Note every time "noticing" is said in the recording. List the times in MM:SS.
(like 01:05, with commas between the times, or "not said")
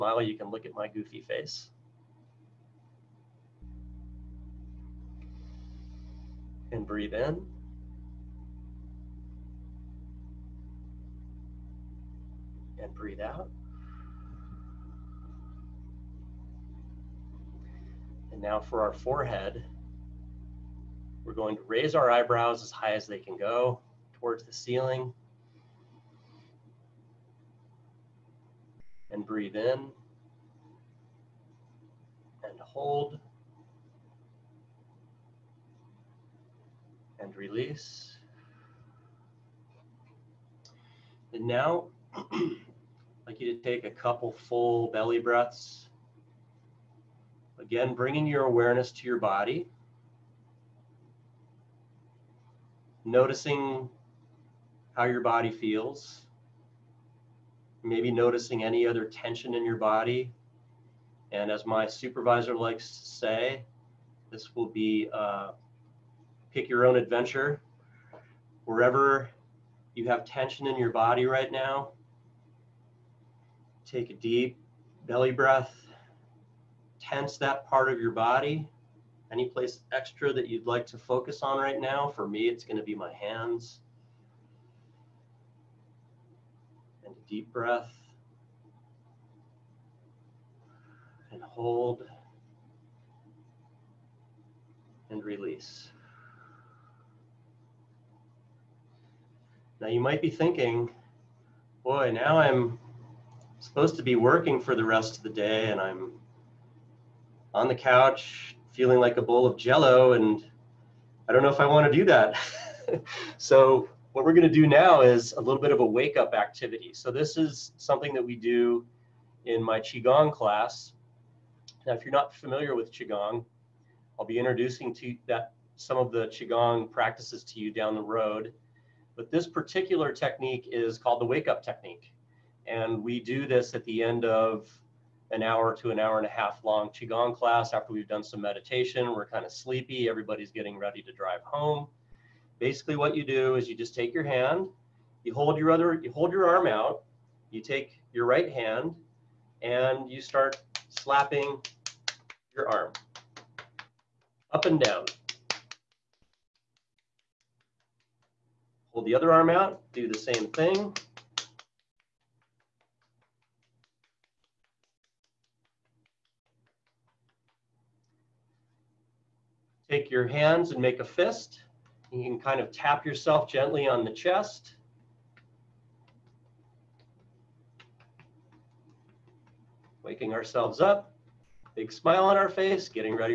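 00:53, 00:58.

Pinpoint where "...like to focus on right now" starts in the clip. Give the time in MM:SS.
01:20.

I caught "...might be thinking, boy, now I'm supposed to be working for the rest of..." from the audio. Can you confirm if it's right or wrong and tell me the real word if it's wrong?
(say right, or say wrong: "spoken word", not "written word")
right.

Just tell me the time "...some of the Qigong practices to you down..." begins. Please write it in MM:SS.
02:05.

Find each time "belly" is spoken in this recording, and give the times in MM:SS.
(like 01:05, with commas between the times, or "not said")
00:44, 01:15.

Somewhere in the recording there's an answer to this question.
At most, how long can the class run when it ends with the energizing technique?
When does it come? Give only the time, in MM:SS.
02:15.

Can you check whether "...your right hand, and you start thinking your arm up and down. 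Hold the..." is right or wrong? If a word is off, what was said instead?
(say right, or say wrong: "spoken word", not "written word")
wrong: "slapping", not "thinking".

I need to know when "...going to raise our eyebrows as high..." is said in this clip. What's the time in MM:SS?
00:21.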